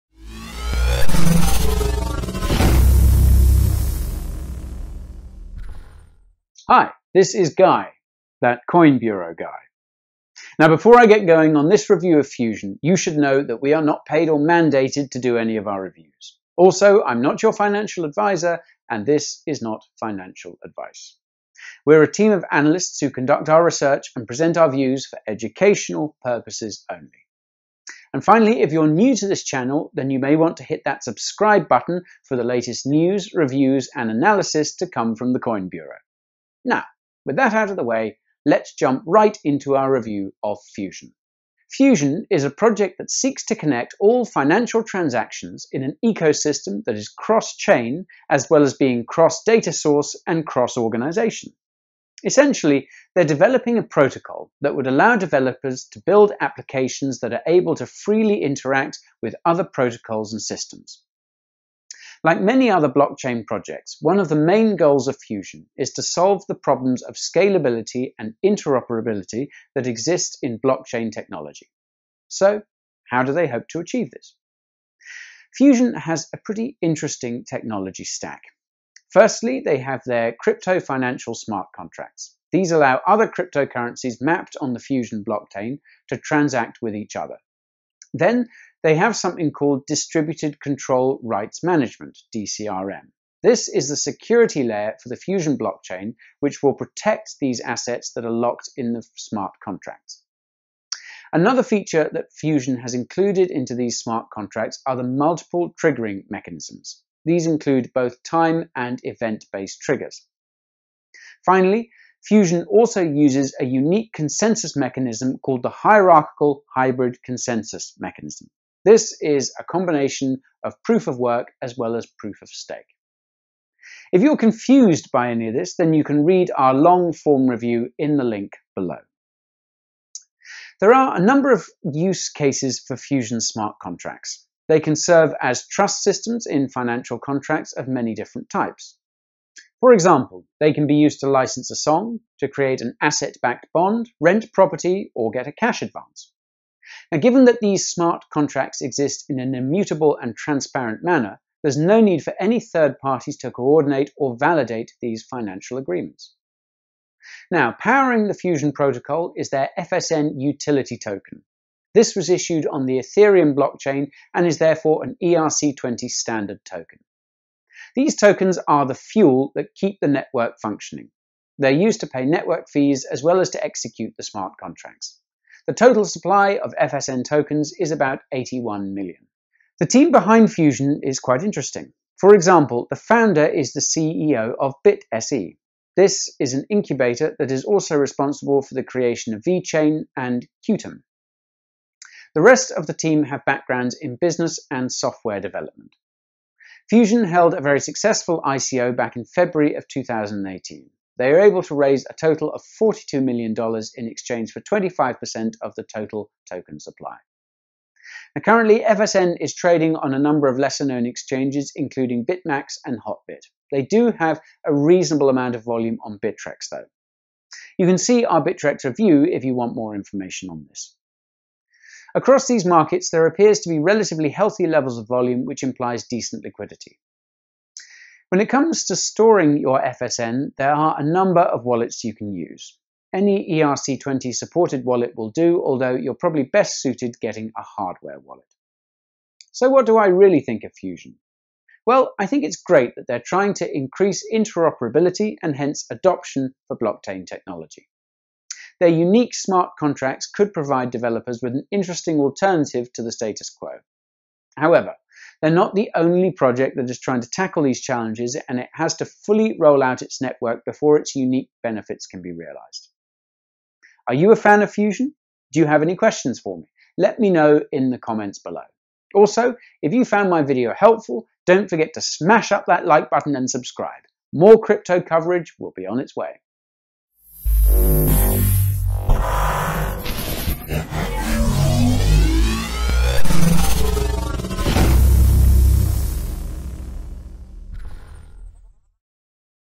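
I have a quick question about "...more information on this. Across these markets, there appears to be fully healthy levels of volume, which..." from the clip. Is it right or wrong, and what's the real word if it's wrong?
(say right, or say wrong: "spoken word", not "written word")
wrong: "relatively", not "fully".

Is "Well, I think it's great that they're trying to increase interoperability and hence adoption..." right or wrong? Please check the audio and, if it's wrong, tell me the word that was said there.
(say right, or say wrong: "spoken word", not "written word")
right.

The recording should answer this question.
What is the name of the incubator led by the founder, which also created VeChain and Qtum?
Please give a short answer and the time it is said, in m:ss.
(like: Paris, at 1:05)
BitSE, at 3:04.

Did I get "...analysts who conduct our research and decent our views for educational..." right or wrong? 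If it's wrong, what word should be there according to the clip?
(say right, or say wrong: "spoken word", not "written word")
wrong: "present", not "decent".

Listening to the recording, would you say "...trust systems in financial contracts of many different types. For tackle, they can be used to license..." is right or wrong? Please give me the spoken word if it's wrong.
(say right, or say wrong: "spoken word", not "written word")
wrong: "example", not "tackle".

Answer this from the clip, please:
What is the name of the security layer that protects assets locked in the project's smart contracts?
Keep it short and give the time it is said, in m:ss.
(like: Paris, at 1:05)
Distributed Control Rights Management, at 1:29.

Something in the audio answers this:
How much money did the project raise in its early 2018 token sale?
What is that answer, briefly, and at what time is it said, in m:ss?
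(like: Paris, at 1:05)
$42 million, at 3:22.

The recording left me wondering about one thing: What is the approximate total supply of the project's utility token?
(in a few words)
81 million.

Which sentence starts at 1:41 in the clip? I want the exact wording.
Another feature that Fusion has included into these smart contracts are the multiple triggering mechanisms.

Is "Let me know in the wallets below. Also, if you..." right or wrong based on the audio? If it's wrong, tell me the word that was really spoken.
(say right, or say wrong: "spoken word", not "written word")
wrong: "comments", not "wallets".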